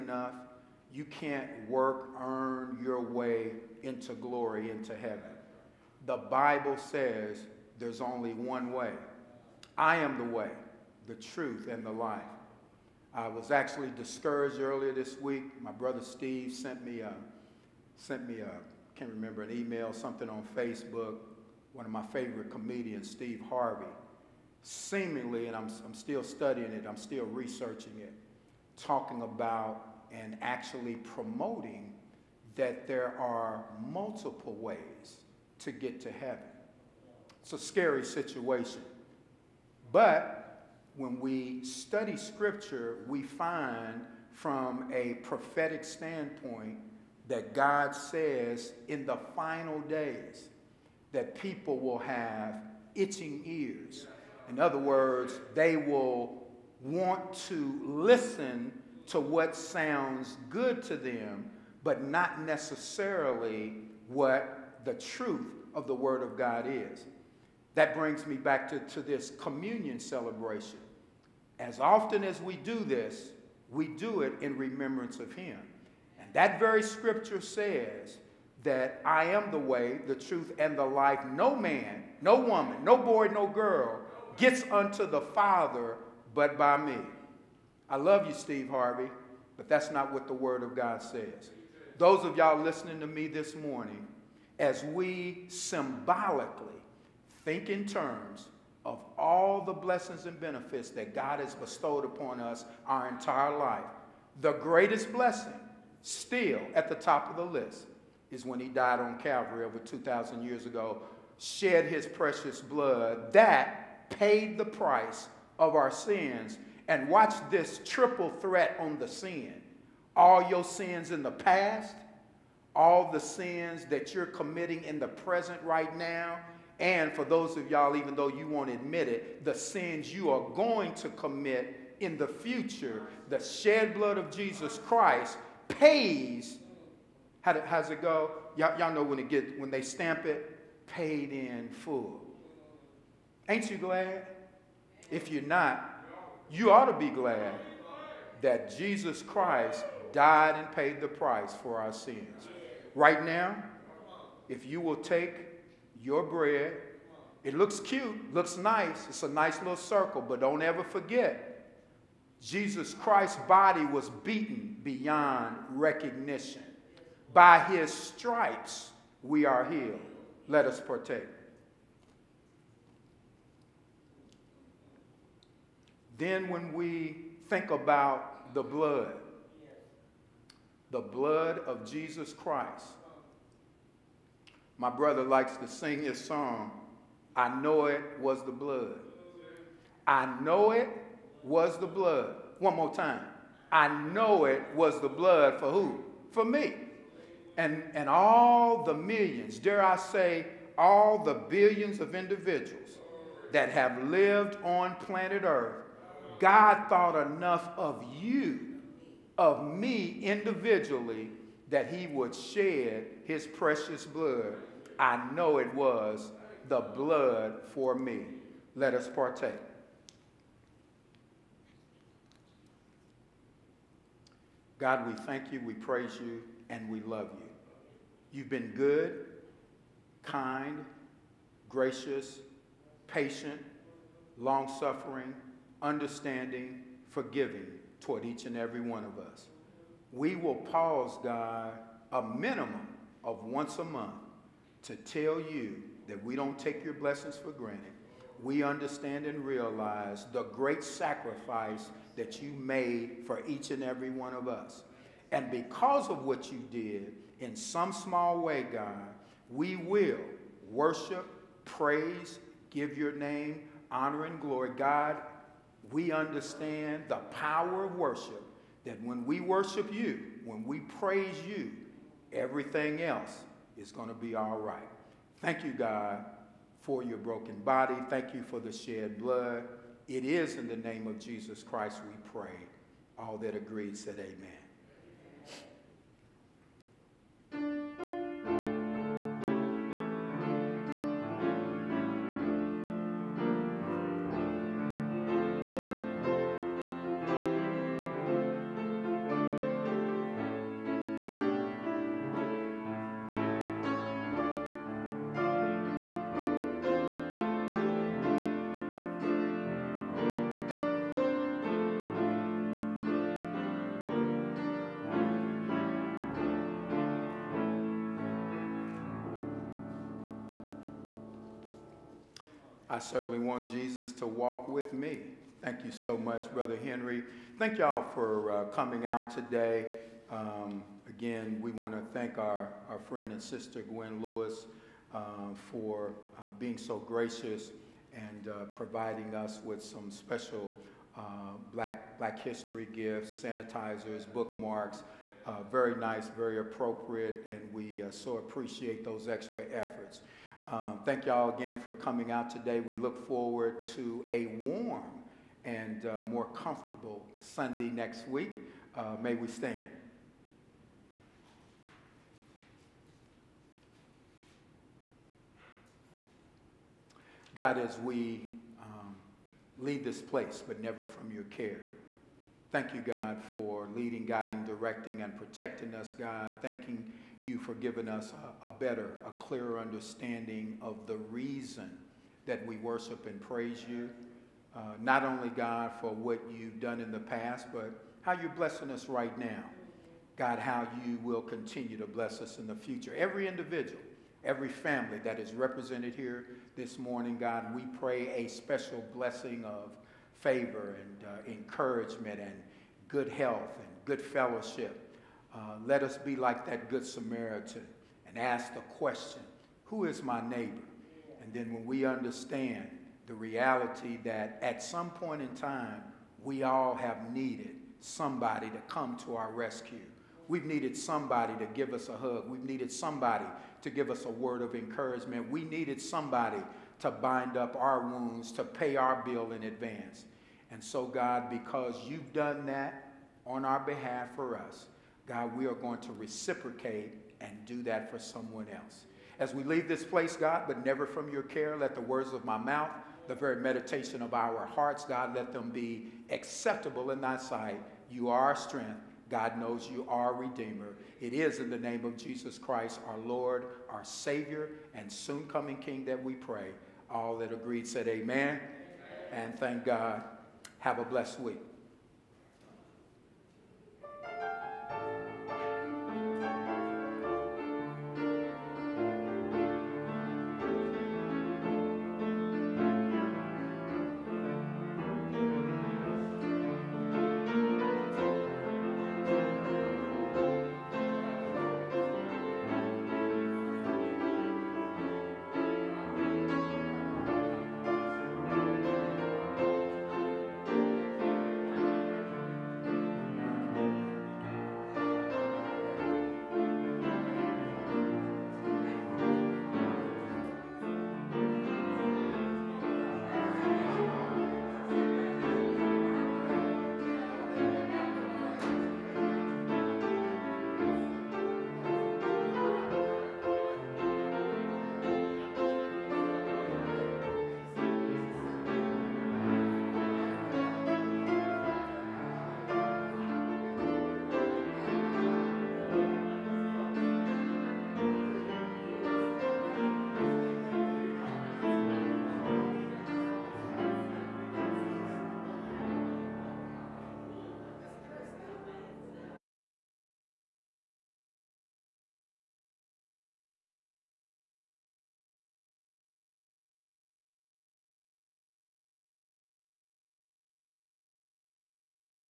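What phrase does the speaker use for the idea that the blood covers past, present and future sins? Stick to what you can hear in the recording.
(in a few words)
triple threat.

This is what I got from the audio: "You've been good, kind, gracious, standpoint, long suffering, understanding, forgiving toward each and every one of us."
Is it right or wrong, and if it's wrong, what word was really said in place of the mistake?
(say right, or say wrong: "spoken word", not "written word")
wrong: "patient", not "standpoint".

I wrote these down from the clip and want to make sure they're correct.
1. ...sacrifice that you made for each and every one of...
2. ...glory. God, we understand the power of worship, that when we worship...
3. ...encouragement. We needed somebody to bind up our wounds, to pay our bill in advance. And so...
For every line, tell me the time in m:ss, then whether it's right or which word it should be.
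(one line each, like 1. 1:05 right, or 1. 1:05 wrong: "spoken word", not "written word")
1. 4:10 right
2. 4:24 right
3. 7:04 right.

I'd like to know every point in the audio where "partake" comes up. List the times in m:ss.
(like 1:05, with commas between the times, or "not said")
2:50, 3:39.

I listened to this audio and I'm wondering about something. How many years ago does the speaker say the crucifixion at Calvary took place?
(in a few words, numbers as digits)
over 2,000 years.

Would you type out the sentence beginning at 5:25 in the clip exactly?
Thank you so much, Brother Henry.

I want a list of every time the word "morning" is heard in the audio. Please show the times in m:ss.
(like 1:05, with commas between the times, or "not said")
1:33, 6:36.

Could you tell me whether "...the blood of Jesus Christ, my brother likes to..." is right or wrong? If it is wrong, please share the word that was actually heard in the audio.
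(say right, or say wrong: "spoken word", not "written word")
right.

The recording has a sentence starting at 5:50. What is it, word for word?
Um, thank y'all again for coming out today.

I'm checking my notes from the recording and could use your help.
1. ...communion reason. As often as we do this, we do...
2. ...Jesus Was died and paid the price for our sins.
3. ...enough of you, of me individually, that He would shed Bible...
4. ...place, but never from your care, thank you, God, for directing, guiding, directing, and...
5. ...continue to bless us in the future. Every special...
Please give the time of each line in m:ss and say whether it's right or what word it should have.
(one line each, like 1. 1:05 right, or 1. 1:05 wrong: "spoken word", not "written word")
1. 1:09 wrong: "celebration", not "reason"
2. 2:28 wrong: "Christ", not "Was"
3. 3:27 wrong: "His", not "Bible"
4. 6:10 wrong: "leading", not "directing"
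5. 6:31 wrong: "individual", not "special".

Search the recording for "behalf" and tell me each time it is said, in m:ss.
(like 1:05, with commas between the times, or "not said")
7:13.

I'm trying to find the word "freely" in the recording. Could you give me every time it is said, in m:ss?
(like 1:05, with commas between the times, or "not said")
not said.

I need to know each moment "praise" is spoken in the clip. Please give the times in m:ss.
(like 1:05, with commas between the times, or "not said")
3:45, 4:21, 4:30, 6:23.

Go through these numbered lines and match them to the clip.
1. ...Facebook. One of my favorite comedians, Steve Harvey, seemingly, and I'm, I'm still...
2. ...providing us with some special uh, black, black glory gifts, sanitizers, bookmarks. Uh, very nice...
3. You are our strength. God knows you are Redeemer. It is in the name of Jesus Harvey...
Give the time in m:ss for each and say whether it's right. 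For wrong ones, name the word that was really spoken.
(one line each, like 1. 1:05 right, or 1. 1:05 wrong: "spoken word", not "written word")
1. 0:20 right
2. 5:38 wrong: "history", not "glory"
3. 7:28 wrong: "Christ", not "Harvey".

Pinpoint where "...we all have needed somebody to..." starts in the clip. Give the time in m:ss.
6:56.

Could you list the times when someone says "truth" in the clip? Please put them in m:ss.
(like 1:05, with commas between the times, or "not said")
0:11, 1:04, 1:20.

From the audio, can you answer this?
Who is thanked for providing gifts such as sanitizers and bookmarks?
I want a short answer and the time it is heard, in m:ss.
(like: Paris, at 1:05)
Gwen Lewis, at 5:33.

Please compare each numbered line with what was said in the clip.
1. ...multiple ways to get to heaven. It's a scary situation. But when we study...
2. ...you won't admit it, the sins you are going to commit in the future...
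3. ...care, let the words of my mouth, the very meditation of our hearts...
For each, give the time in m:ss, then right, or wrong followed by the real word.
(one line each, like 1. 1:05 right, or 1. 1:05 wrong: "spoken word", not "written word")
1. 0:33 right
2. 2:08 right
3. 7:21 right.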